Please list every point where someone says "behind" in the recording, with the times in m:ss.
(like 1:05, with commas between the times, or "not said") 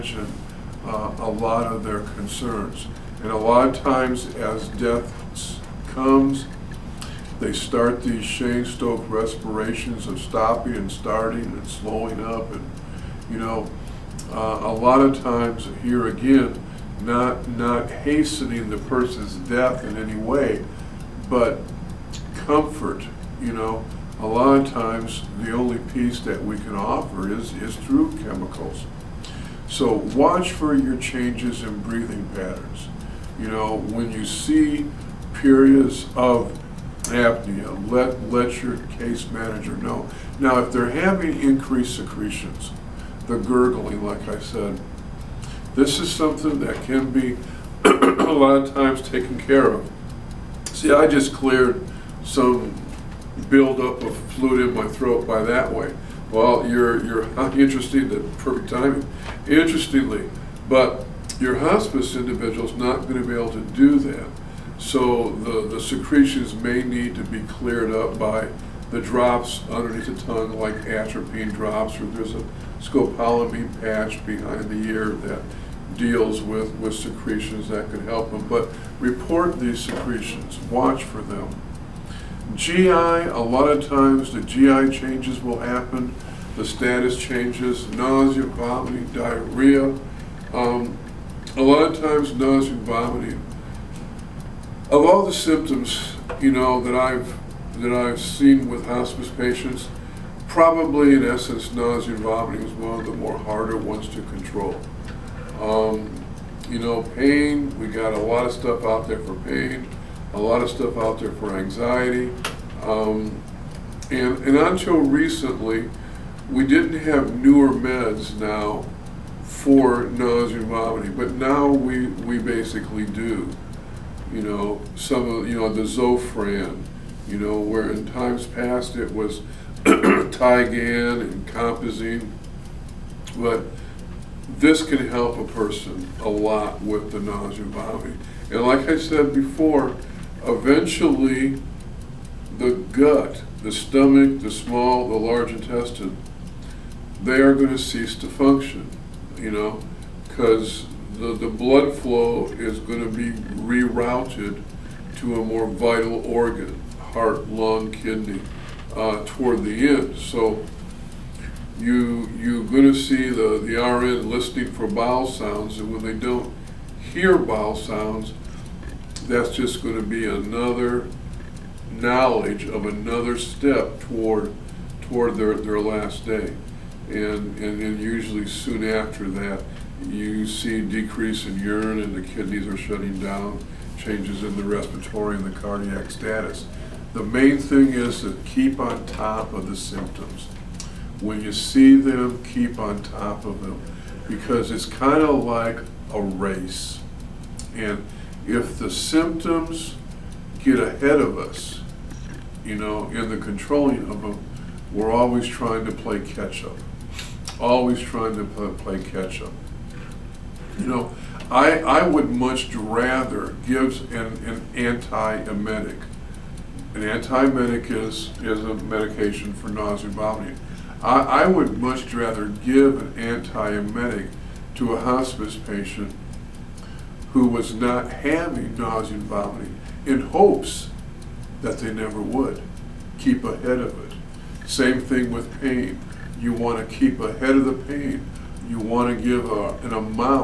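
1:14.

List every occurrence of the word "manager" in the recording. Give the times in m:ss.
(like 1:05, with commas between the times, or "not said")
0:39.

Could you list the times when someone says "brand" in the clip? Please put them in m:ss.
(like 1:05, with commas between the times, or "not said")
not said.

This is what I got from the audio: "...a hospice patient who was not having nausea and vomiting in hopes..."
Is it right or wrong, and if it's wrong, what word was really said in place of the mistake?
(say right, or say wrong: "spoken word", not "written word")
right.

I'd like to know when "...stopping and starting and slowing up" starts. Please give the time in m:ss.
0:10.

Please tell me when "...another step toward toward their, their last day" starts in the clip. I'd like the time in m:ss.
2:52.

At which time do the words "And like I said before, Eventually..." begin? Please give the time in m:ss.
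2:18.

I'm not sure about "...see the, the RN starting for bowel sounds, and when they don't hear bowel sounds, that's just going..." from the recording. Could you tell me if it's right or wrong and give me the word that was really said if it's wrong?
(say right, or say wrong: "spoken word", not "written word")
wrong: "listening", not "starting".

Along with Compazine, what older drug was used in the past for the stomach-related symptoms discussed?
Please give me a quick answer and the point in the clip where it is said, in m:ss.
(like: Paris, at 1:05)
Tigan, at 2:09.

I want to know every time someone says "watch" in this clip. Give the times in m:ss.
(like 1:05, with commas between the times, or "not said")
0:30, 1:20.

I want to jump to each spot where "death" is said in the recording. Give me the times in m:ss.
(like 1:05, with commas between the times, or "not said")
0:04, 0:19.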